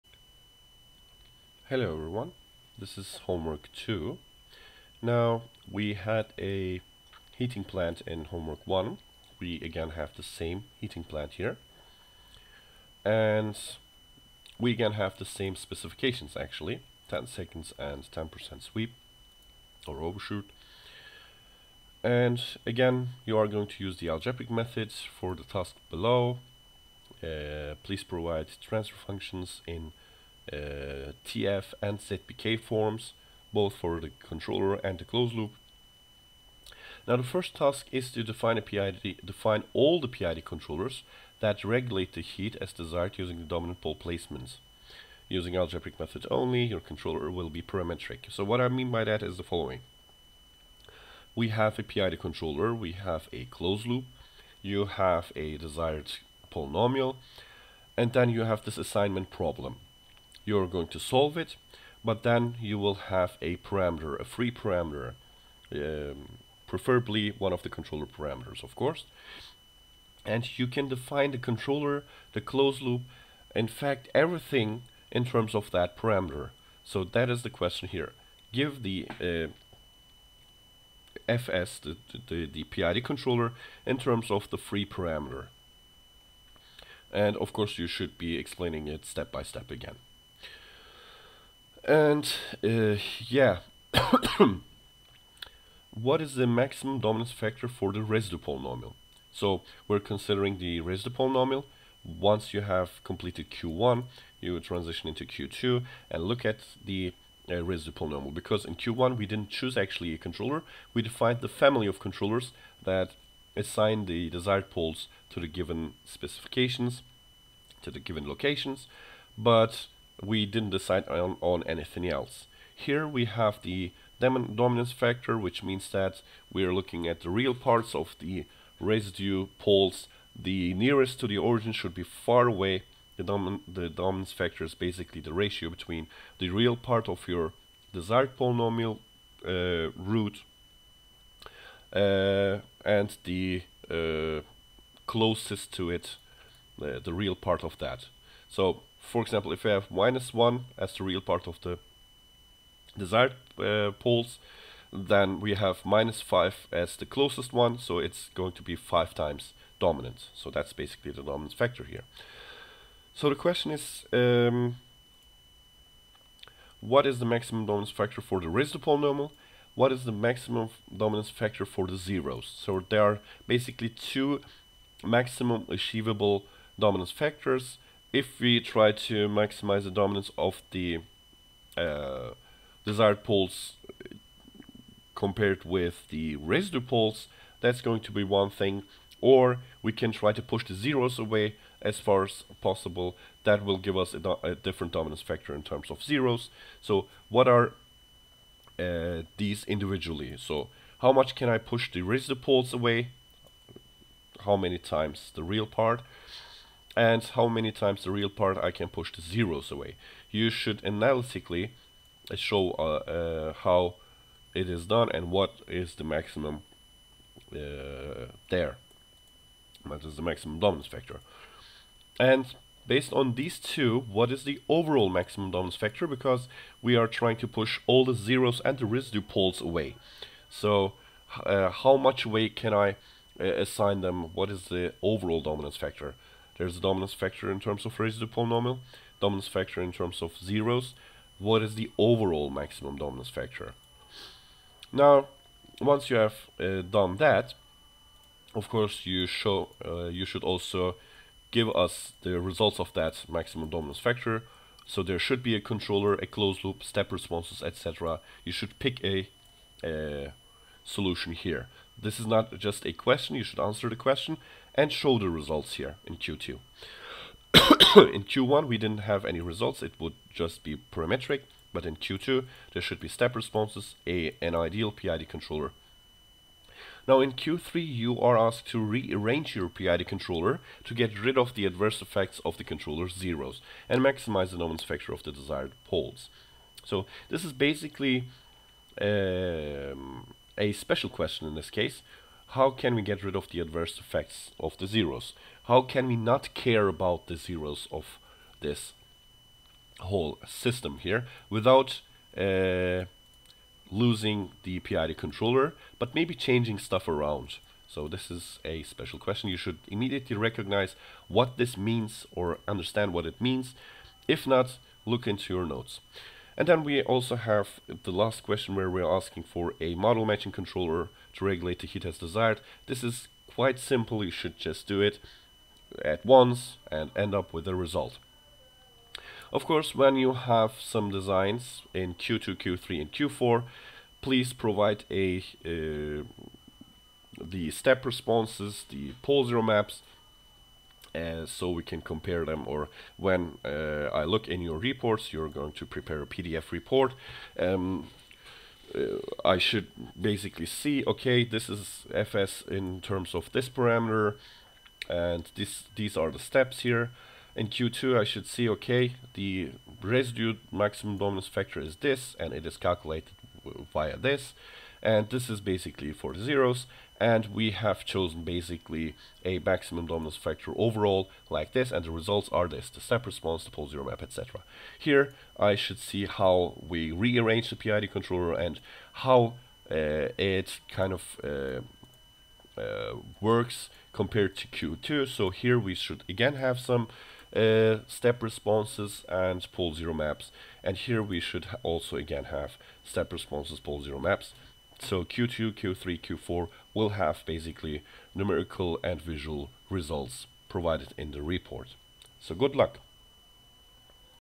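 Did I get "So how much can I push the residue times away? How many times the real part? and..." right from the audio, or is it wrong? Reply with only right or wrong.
wrong.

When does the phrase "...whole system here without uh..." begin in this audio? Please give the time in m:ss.
4:59.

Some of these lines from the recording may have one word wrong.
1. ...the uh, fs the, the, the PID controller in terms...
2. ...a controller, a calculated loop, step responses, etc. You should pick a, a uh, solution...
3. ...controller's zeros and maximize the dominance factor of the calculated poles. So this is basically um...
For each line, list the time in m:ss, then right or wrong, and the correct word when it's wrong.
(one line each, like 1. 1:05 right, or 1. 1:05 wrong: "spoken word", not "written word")
1. 1:18 right
2. 4:15 wrong: "closed", not "calculated"
3. 4:42 wrong: "desired", not "calculated".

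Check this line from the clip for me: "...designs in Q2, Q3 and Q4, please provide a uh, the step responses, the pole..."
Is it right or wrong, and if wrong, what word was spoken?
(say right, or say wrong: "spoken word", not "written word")
right.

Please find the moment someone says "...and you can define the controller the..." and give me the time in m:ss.
1:10.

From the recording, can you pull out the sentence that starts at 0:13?
And we again have the same specifications actually, 10 seconds and 10% sweep or overshoot.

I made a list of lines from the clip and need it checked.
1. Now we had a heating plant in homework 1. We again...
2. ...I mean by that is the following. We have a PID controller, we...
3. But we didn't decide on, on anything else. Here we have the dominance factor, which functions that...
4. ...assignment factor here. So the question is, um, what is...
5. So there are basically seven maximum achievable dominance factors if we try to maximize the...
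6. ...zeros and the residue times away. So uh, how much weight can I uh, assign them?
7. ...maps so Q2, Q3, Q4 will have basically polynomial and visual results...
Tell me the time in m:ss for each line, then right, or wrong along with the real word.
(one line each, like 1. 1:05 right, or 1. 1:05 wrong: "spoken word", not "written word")
1. 0:05 right
2. 0:48 right
3. 1:59 wrong: "means", not "functions"
4. 2:41 wrong: "dominant", not "assignment"
5. 2:52 wrong: "two", not "seven"
6. 3:48 wrong: "poles", not "times"
7. 6:34 wrong: "numerical", not "polynomial".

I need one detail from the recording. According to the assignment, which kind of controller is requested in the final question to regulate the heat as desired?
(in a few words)
model matching controller.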